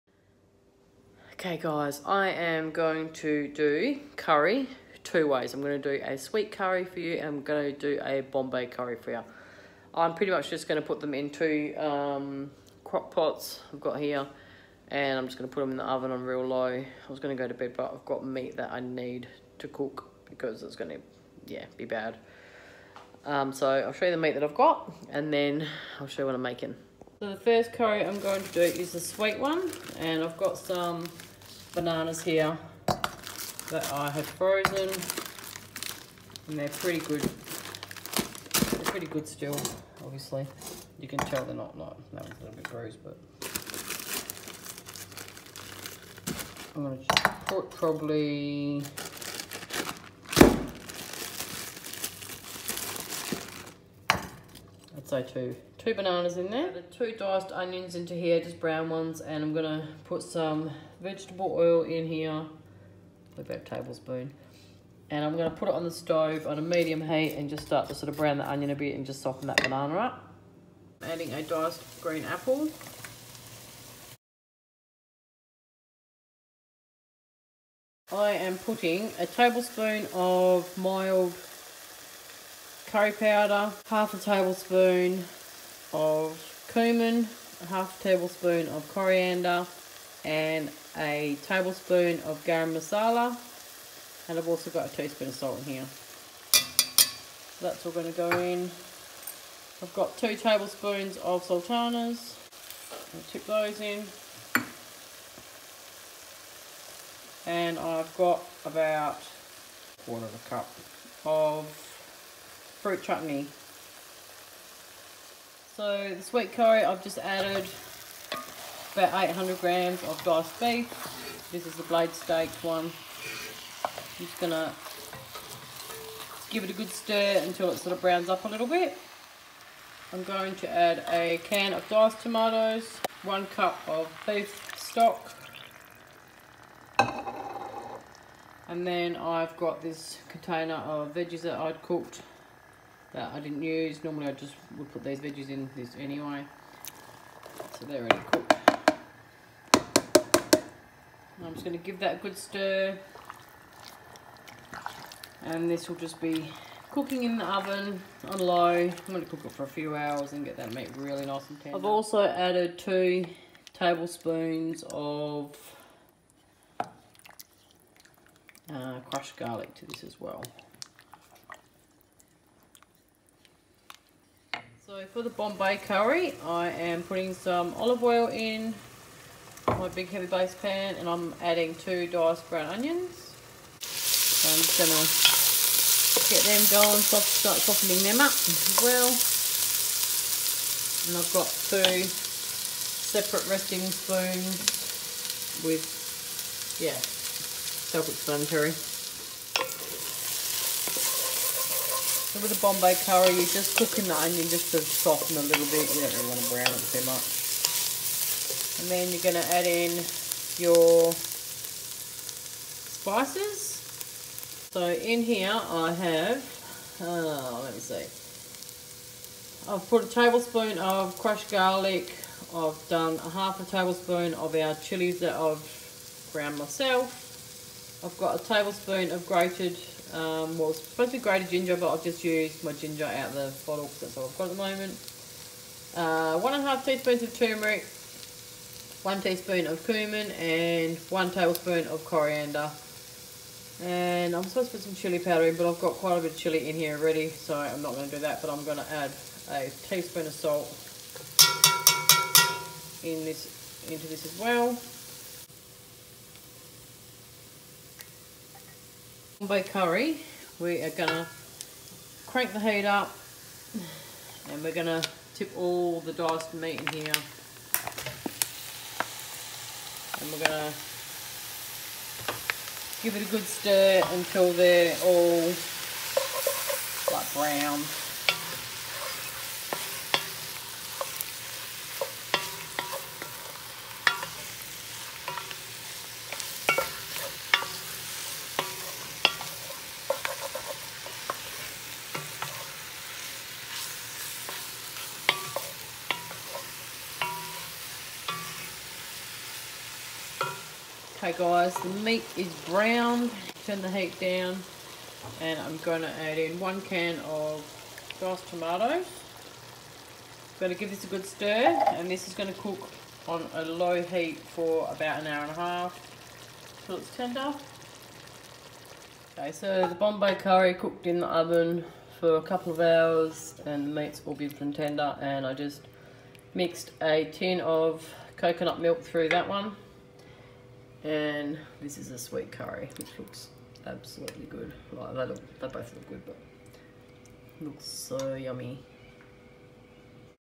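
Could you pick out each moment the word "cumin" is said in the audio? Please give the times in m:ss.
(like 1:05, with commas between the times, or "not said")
1:26, 3:59.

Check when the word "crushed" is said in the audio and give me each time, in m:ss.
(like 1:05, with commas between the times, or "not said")
2:49, 3:41.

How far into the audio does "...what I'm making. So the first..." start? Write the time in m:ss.
0:26.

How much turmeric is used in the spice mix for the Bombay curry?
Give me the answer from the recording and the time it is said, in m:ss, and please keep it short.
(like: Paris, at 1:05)
1.5 teaspoons, at 3:56.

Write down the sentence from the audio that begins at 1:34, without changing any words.
And I've also got a teaspoon of salt in here.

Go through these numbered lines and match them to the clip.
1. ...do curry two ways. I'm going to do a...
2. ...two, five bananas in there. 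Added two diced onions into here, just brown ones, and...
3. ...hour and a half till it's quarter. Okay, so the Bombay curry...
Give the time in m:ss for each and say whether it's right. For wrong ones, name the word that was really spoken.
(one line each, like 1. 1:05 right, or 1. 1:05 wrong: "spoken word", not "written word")
1. 0:03 right
2. 0:55 wrong: "two", not "five"
3. 5:15 wrong: "tender", not "quarter".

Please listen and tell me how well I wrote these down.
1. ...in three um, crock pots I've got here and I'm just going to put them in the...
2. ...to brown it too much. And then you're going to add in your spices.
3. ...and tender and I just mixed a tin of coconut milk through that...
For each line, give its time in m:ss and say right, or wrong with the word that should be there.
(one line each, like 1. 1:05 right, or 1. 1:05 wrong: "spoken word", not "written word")
1. 0:11 wrong: "two", not "three"
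2. 3:26 right
3. 5:24 right.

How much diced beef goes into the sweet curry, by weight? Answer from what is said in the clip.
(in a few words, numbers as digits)
800 grams.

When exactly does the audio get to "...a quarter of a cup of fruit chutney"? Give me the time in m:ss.
1:49.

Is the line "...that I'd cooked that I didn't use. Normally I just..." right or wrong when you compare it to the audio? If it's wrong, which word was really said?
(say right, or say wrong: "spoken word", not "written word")
right.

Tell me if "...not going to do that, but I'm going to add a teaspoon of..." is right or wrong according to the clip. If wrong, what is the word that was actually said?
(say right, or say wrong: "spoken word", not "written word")
right.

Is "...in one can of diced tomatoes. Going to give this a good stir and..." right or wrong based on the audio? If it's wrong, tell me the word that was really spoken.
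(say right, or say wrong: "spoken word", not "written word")
right.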